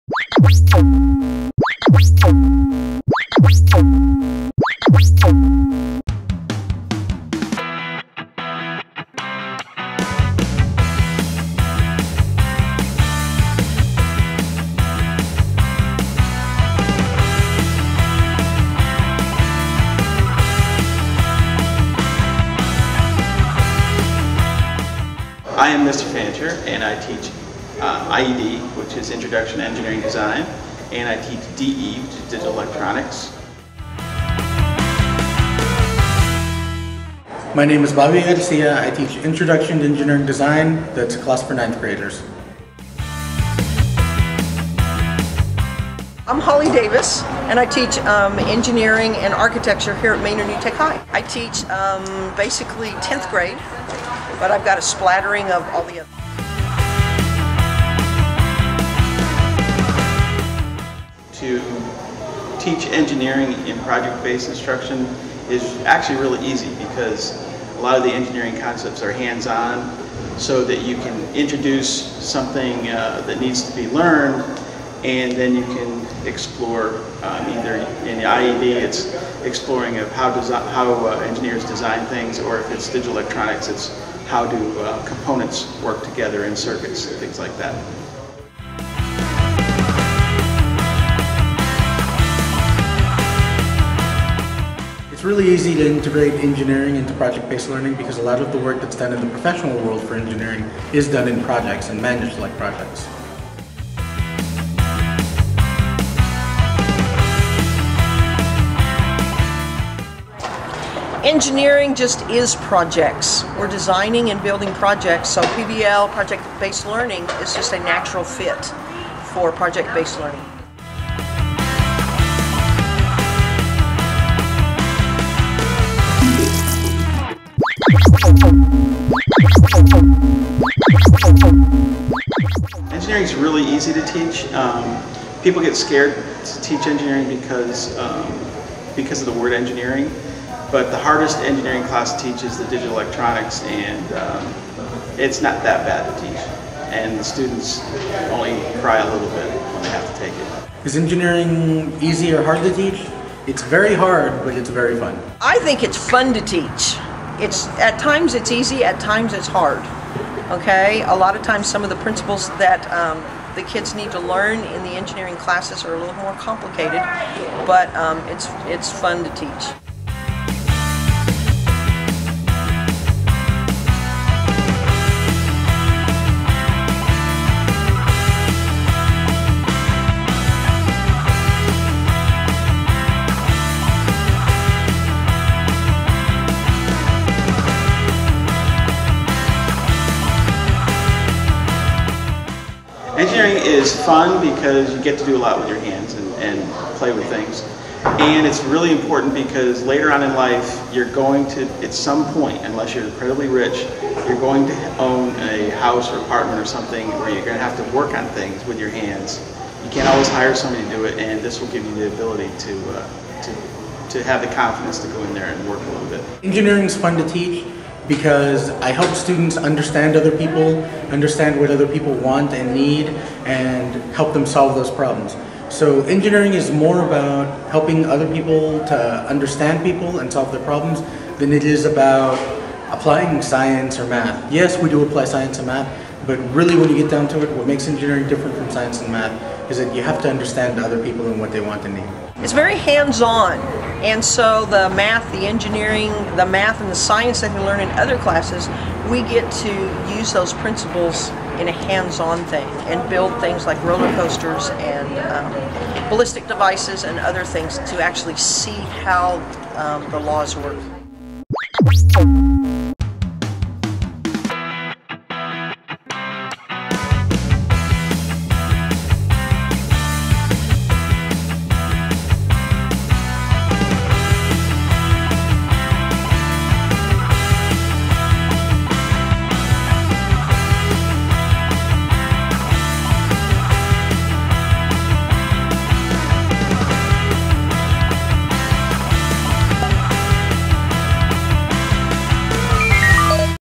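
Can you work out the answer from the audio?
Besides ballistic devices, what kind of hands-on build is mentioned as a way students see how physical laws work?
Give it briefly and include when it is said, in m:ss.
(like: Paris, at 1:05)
roller coasters, at 4:13.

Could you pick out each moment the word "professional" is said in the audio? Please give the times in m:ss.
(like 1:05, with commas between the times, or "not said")
1:39.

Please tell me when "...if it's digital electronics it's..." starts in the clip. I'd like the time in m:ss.
1:22.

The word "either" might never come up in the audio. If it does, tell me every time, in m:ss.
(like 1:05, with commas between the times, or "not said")
1:17.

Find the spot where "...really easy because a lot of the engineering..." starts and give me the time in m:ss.
1:06.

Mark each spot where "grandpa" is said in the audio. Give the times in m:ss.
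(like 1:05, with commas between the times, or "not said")
not said.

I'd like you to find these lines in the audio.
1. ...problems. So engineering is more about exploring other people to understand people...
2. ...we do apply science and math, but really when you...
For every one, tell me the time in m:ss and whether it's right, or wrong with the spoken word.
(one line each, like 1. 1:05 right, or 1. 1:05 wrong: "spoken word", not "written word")
1. 3:44 wrong: "helping", not "exploring"
2. 3:54 right.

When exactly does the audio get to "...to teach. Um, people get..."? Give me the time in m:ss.
2:13.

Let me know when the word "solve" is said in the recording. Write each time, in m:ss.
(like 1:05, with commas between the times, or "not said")
3:44, 3:50.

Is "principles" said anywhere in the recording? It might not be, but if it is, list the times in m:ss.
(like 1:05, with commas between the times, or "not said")
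2:41, 4:10.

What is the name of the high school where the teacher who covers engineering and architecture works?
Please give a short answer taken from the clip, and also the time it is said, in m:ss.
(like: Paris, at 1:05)
Manor New Tech High, at 0:50.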